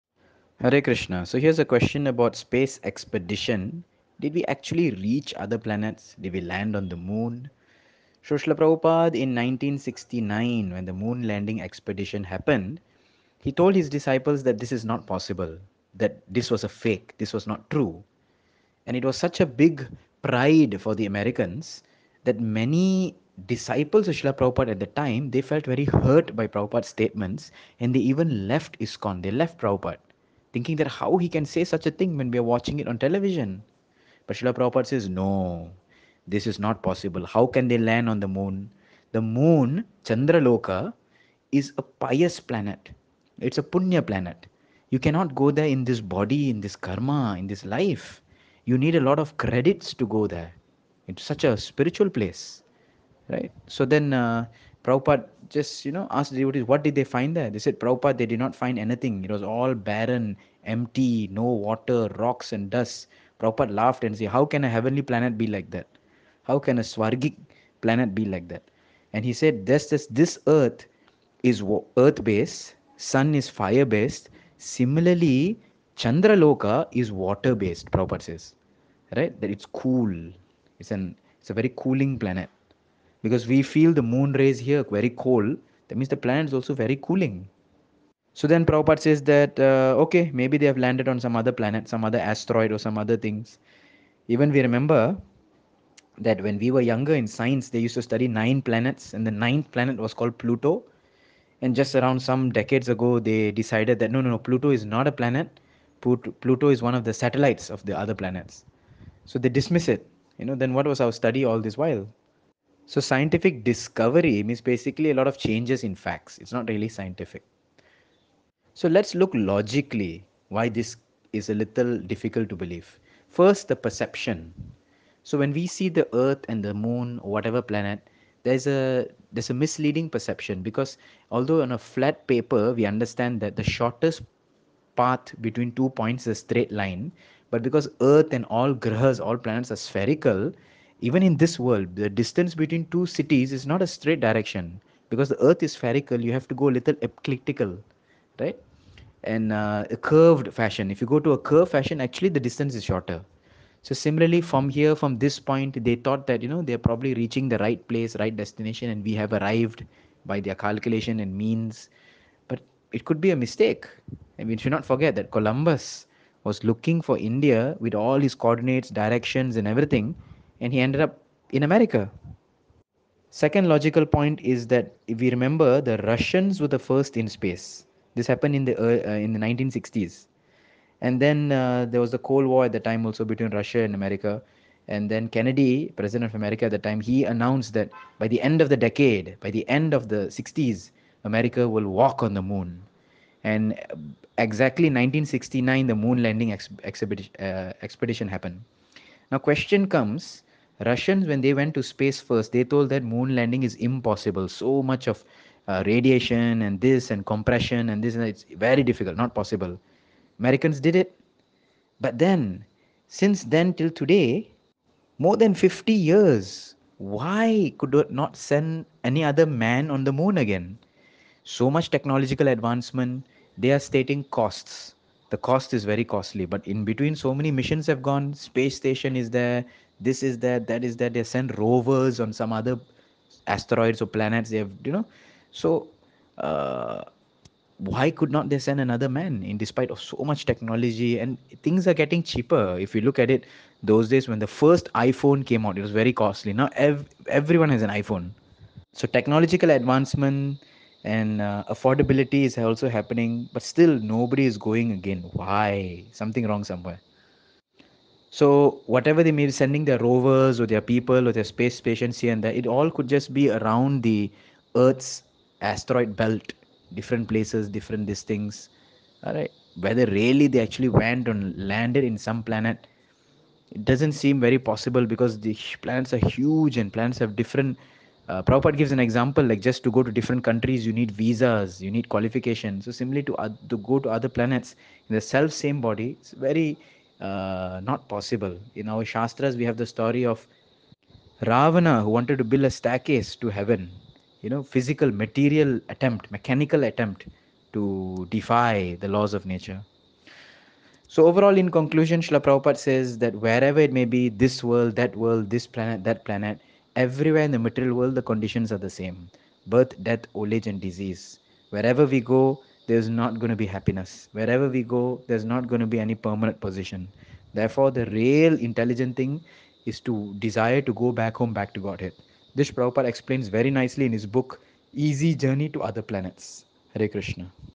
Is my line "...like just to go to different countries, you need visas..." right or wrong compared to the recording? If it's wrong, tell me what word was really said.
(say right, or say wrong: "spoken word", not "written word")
right.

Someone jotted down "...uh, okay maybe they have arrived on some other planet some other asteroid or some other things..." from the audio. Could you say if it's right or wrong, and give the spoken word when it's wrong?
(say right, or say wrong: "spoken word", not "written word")
wrong: "landed", not "arrived".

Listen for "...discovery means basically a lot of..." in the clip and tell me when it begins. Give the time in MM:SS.
01:53.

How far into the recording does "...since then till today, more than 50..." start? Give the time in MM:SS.
03:33.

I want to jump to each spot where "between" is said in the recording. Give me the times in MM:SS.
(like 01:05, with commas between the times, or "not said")
02:15, 02:22, 03:03, 03:46.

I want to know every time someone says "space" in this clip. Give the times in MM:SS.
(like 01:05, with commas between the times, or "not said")
00:02, 02:57, 03:21, 03:48, 04:21.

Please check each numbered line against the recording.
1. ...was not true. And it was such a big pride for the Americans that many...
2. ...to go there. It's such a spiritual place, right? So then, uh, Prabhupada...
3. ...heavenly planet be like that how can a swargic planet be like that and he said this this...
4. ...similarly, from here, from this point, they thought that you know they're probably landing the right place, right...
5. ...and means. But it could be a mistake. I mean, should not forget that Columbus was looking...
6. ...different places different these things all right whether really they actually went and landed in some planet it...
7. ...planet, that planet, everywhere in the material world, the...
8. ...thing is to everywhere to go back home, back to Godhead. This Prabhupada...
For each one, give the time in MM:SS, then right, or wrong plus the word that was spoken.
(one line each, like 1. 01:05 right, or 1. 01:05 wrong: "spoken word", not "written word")
1. 00:17 right
2. 00:49 right
3. 01:04 right
4. 02:33 wrong: "reaching", not "landing"
5. 02:41 right
6. 04:26 right
7. 05:05 right
8. 05:19 wrong: "desire", not "everywhere".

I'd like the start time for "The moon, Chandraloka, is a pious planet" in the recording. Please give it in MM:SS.
00:39.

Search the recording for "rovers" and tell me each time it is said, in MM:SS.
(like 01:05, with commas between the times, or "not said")
03:51, 04:19.